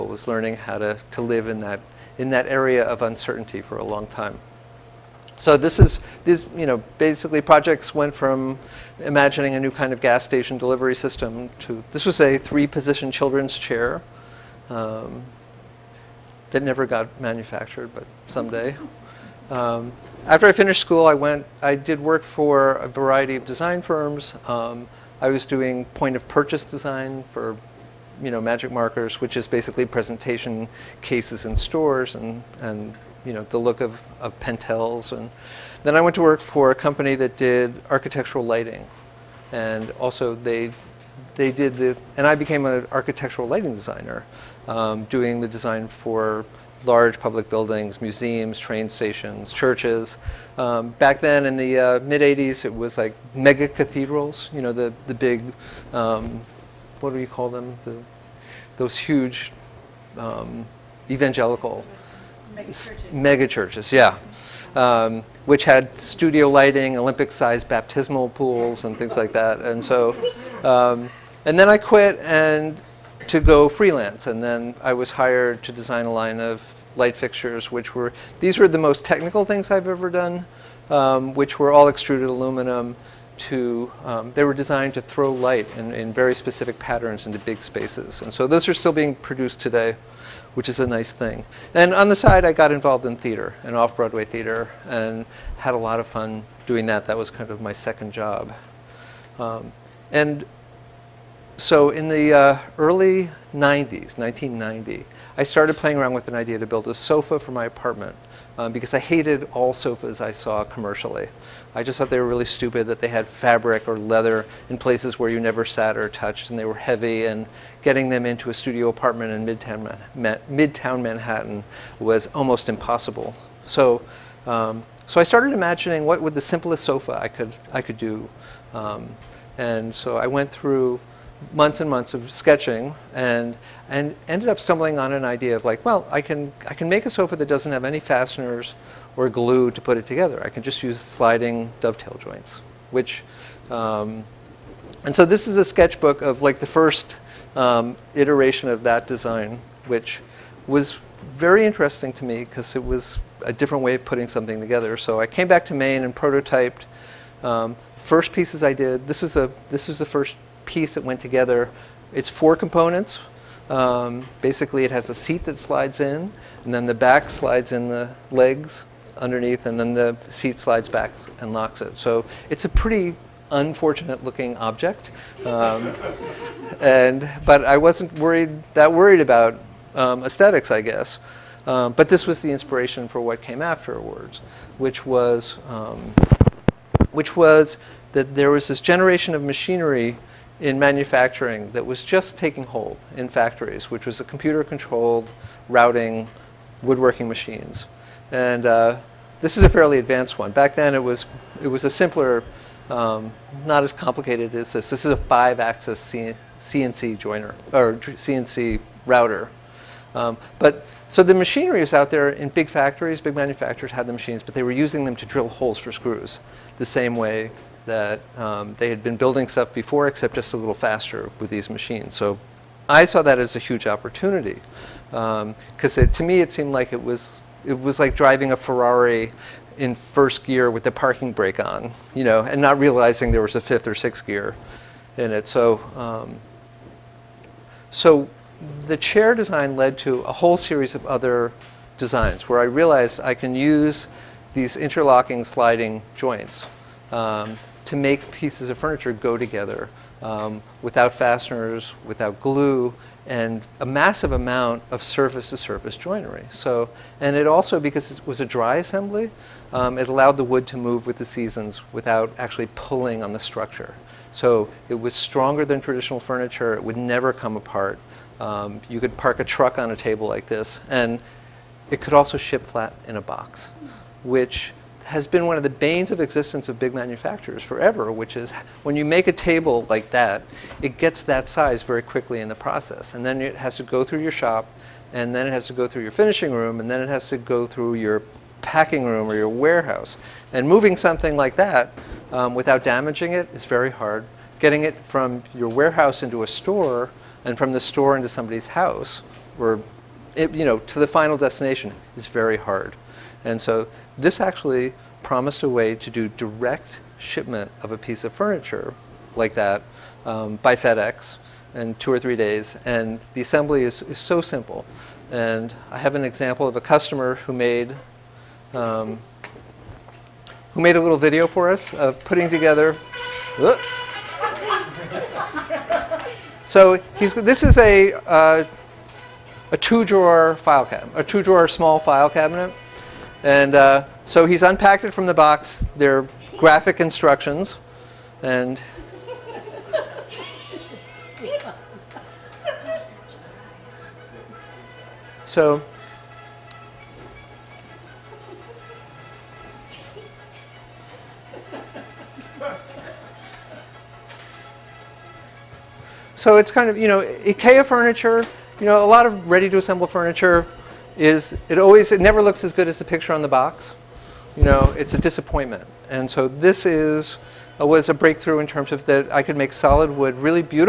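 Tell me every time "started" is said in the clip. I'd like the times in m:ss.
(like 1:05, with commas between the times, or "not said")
1:45, 2:05.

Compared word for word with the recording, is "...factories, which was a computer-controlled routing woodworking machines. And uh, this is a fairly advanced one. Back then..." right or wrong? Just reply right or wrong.
right.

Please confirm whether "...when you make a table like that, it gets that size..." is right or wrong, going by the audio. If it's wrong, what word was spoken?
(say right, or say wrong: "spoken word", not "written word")
right.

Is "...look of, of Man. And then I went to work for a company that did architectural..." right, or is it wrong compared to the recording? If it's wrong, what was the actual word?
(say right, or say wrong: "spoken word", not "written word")
wrong: "Pentels", not "Man".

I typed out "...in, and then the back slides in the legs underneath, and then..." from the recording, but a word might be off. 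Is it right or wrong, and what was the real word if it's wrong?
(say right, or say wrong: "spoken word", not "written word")
right.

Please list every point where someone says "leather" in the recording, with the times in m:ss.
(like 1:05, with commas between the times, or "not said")
1:53.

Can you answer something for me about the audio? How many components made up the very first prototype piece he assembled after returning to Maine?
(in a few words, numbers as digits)
4.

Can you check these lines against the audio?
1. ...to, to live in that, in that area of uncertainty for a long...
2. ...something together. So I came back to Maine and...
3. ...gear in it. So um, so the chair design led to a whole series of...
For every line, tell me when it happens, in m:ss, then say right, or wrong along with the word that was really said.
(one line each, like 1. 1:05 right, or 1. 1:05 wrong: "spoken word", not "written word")
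1. 0:00 right
2. 2:34 right
3. 3:54 right.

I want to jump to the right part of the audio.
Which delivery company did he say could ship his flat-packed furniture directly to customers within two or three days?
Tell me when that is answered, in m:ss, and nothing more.
5:10.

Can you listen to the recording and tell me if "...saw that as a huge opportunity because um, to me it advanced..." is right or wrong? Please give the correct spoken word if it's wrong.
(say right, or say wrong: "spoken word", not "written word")
wrong: "seemed", not "advanced".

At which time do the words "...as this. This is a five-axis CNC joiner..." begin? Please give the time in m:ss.
3:24.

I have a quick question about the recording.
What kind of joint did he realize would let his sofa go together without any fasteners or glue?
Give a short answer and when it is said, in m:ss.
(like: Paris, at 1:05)
Sliding dovetail joints, at 2:20.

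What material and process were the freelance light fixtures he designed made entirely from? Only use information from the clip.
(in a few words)
Extruded aluminum.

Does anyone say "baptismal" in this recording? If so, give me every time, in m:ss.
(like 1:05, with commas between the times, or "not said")
1:07.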